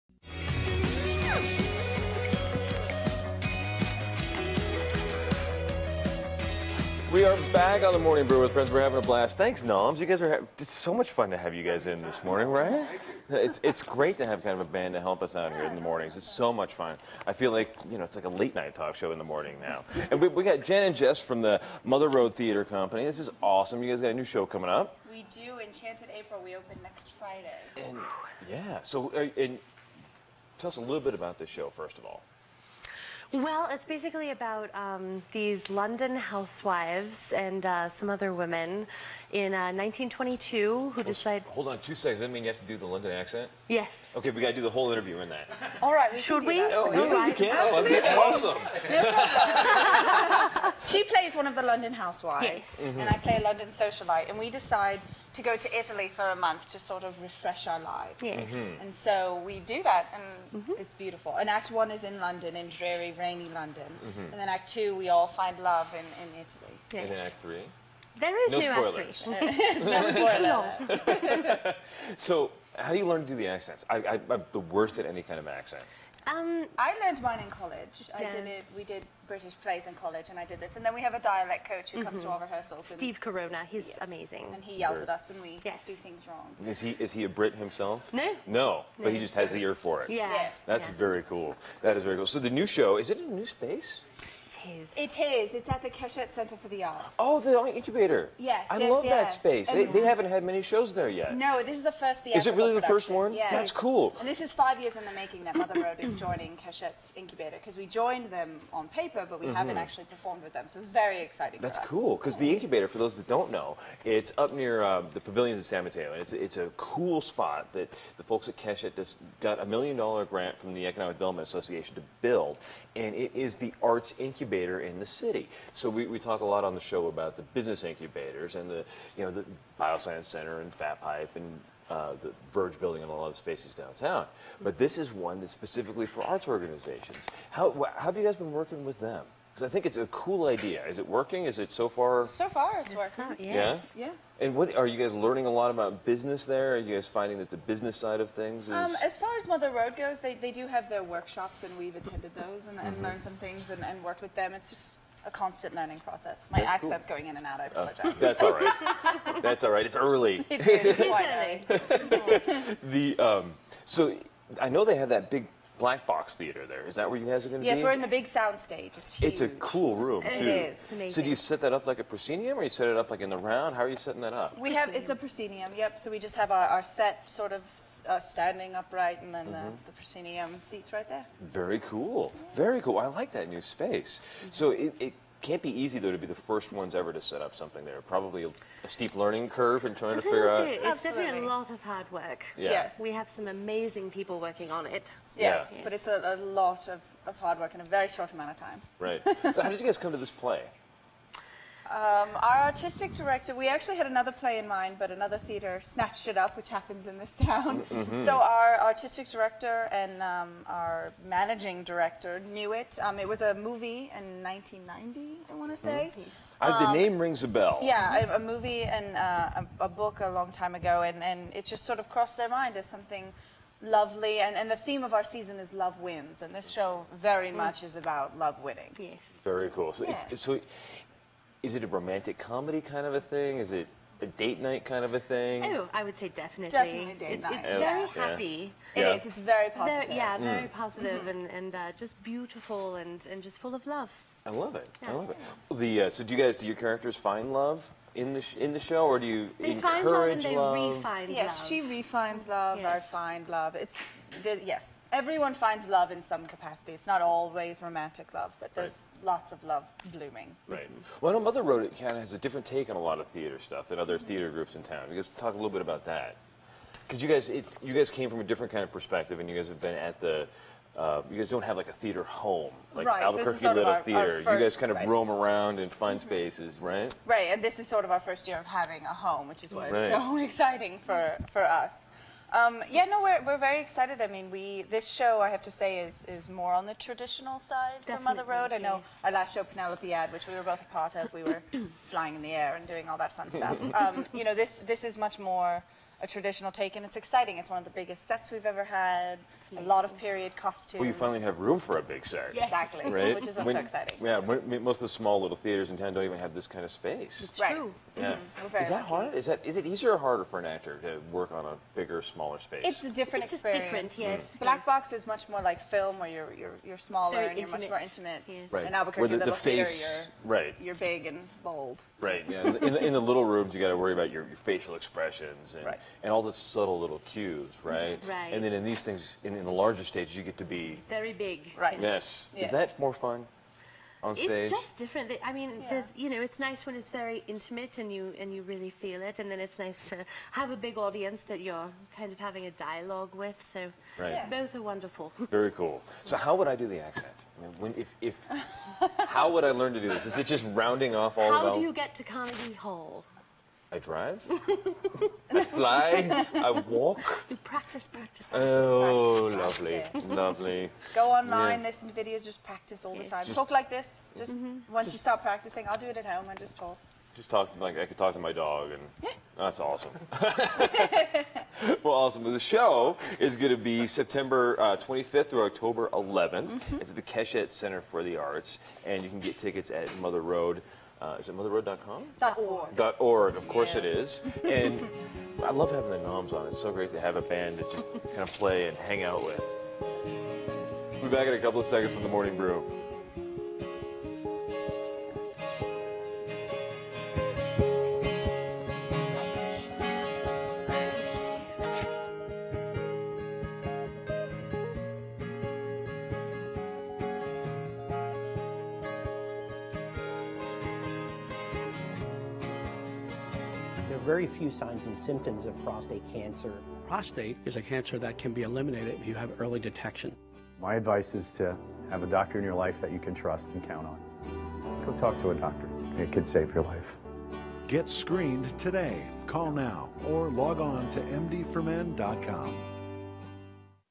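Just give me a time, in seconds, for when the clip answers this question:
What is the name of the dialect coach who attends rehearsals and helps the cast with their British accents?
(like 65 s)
82 s.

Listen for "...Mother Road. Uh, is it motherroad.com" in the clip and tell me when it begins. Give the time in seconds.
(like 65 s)
380 s.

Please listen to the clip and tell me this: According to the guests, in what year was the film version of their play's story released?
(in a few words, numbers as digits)
1990.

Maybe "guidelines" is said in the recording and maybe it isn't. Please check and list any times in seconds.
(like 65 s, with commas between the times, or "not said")
not said.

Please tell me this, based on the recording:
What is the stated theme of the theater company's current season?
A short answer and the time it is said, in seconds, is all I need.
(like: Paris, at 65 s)
love wins, at 225 s.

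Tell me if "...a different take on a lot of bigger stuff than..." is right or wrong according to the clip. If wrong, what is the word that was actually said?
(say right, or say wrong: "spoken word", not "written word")
wrong: "theater", not "bigger".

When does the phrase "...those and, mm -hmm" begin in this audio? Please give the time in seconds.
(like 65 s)
152 s.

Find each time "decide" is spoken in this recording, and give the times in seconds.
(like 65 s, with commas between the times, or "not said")
41 s, 54 s.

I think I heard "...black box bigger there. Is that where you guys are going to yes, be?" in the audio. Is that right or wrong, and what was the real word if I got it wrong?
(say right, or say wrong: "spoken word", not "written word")
wrong: "theater", not "bigger".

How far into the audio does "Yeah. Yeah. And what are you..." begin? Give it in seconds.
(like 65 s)
143 s.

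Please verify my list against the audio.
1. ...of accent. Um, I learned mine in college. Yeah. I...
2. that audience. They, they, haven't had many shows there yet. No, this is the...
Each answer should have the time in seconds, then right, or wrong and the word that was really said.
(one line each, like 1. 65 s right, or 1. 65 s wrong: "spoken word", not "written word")
1. 75 s right
2. 99 s wrong: "space", not "audience".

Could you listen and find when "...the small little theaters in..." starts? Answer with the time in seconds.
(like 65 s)
305 s.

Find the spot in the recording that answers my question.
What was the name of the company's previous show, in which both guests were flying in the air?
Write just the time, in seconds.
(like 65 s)
289 s.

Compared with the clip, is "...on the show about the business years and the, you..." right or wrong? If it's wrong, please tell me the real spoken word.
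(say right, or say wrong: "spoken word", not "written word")
wrong: "incubators", not "years".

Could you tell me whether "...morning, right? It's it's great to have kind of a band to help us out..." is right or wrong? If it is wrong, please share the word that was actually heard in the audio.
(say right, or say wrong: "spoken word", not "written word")
right.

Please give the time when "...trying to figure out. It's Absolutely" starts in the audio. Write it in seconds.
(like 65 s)
189 s.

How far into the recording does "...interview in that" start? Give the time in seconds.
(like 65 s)
44 s.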